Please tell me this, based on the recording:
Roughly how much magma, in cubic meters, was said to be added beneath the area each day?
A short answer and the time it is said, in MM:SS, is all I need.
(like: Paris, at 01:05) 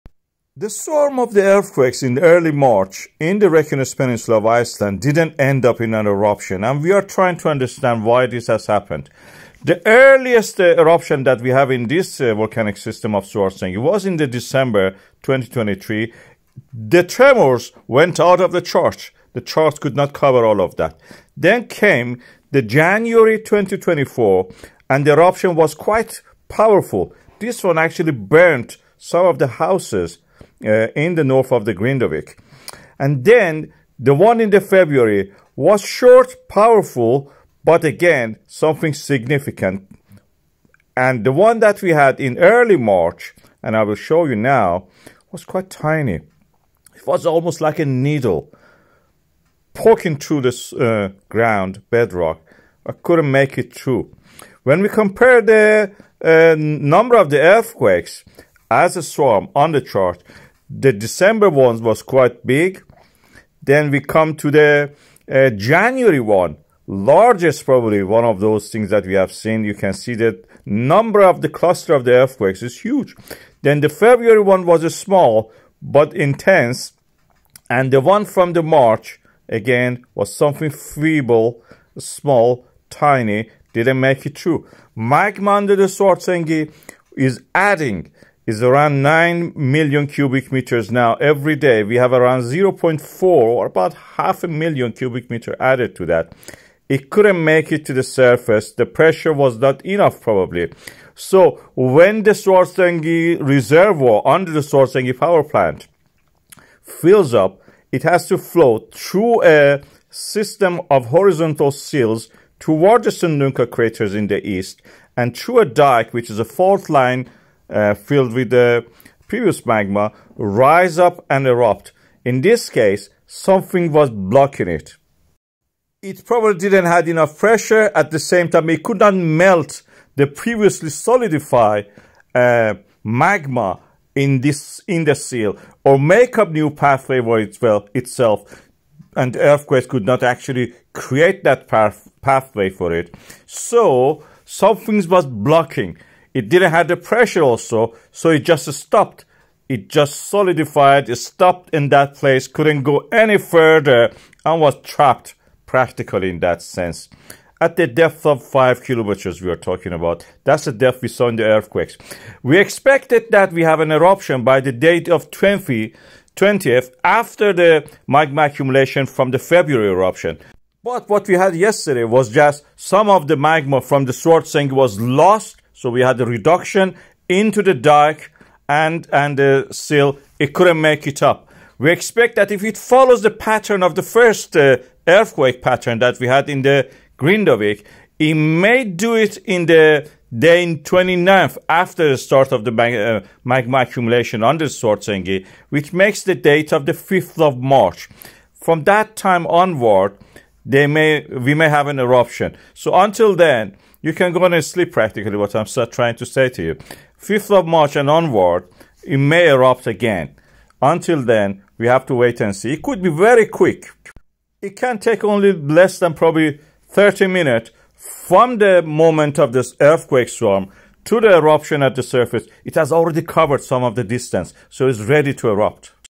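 9 million cubic meters, at 01:29.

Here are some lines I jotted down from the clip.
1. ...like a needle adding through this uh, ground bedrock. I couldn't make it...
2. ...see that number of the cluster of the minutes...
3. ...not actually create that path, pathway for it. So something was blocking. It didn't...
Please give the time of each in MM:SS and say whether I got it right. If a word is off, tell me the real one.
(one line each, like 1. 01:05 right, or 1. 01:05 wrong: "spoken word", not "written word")
1. 00:47 wrong: "poking", not "adding"
2. 01:09 wrong: "earthquakes", not "minutes"
3. 02:20 right.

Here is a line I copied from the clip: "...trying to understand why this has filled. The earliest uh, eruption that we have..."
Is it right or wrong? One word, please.
wrong.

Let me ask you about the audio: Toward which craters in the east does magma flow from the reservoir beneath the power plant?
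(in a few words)
Sundhnúka craters.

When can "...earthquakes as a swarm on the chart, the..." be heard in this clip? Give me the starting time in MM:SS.
00:57.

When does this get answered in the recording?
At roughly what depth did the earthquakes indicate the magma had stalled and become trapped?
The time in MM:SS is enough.
02:38.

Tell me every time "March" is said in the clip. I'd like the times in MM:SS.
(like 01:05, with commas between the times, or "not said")
00:02, 00:42, 01:18, 03:17, 03:27.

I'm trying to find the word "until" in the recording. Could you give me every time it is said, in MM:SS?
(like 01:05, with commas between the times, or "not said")
03:22, 03:30.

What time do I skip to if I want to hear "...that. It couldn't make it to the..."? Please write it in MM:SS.
01:36.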